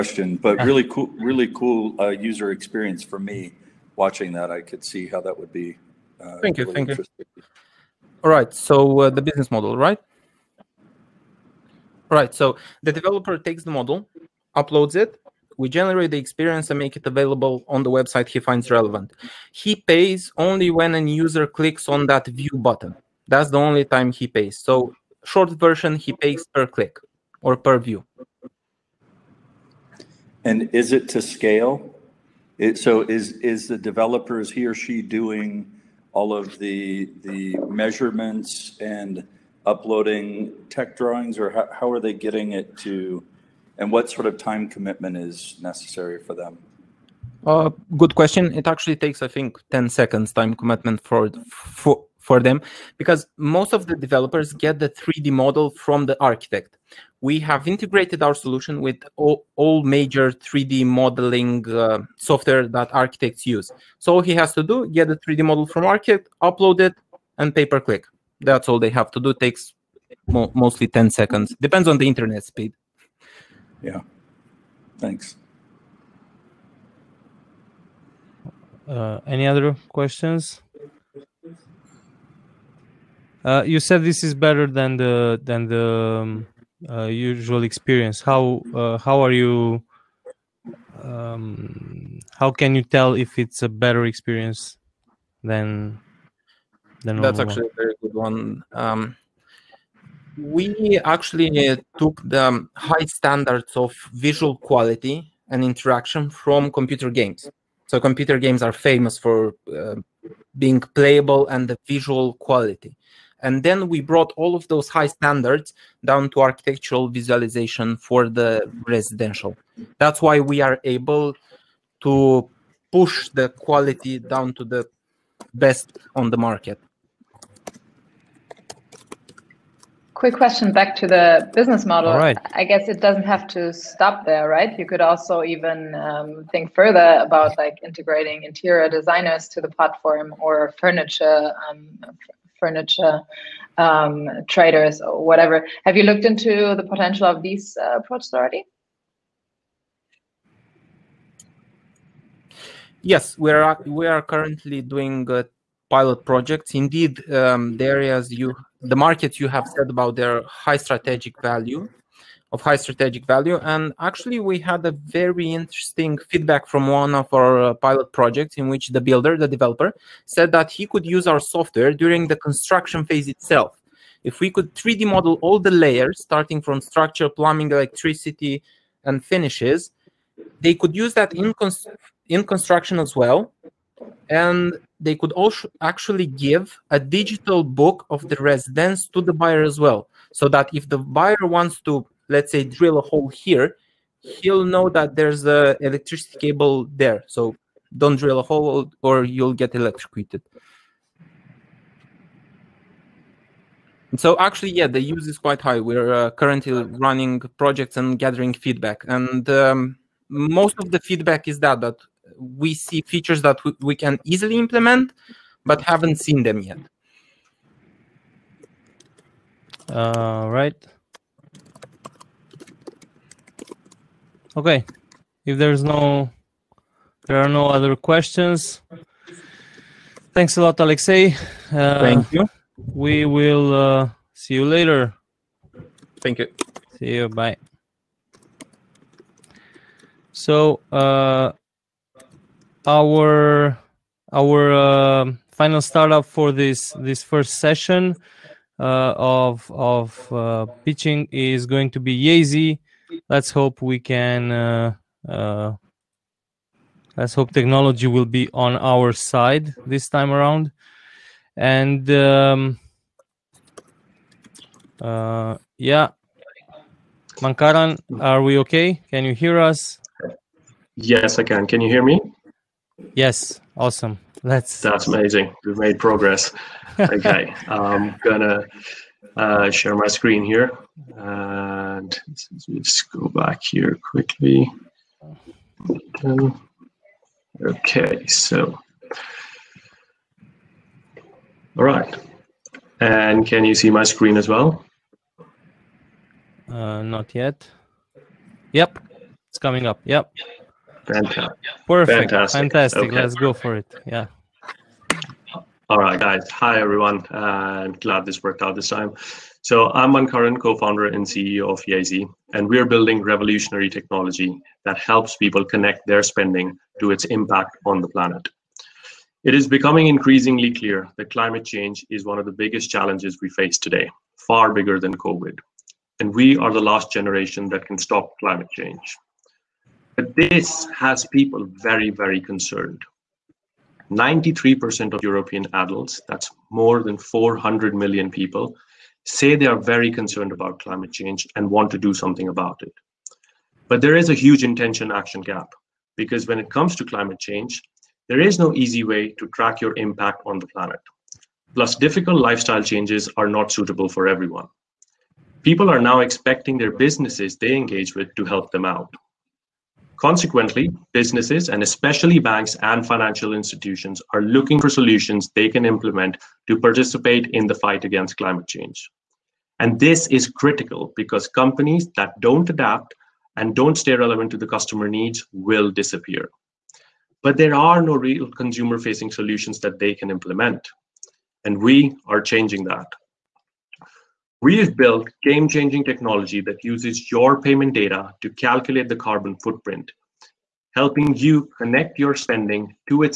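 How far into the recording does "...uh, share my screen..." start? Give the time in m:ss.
4:39.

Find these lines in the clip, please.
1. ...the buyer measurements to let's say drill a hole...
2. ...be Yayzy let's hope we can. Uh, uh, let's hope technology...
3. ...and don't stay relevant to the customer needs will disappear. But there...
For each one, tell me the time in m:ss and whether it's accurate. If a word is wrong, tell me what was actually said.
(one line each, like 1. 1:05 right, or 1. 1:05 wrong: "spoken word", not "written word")
1. 3:10 wrong: "wants", not "measurements"
2. 4:11 right
3. 6:13 right.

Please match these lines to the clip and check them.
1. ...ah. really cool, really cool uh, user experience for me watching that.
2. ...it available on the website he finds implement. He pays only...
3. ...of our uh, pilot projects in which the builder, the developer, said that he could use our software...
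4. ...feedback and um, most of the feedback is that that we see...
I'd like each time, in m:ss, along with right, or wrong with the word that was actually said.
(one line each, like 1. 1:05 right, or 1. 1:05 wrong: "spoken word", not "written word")
1. 0:00 right
2. 0:16 wrong: "relevant", not "implement"
3. 2:47 right
4. 3:28 right.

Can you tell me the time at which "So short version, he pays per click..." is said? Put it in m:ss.
0:24.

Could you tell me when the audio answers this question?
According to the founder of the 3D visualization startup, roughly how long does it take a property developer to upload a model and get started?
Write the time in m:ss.
0:49.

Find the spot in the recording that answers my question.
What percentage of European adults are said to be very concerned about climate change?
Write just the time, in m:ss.
5:34.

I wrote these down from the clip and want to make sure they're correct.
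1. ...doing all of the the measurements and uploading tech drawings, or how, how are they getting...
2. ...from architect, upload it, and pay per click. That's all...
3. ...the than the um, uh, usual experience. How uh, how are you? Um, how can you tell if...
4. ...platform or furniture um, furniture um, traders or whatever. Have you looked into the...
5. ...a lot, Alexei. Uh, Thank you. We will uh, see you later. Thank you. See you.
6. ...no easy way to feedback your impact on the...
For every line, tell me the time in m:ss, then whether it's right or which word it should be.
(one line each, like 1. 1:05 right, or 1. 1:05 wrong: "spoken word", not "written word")
1. 0:35 right
2. 1:05 right
3. 1:24 right
4. 2:19 right
5. 3:50 right
6. 5:48 wrong: "track", not "feedback".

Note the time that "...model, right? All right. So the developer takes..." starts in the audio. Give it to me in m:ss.
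0:09.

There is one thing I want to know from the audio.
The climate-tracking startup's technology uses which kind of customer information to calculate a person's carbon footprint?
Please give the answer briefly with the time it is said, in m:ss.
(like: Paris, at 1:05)
payment data, at 6:27.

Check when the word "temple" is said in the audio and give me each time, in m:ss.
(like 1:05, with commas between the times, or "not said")
not said.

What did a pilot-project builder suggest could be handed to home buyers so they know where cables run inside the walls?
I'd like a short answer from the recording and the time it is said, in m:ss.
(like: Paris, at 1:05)
a digital book, at 3:06.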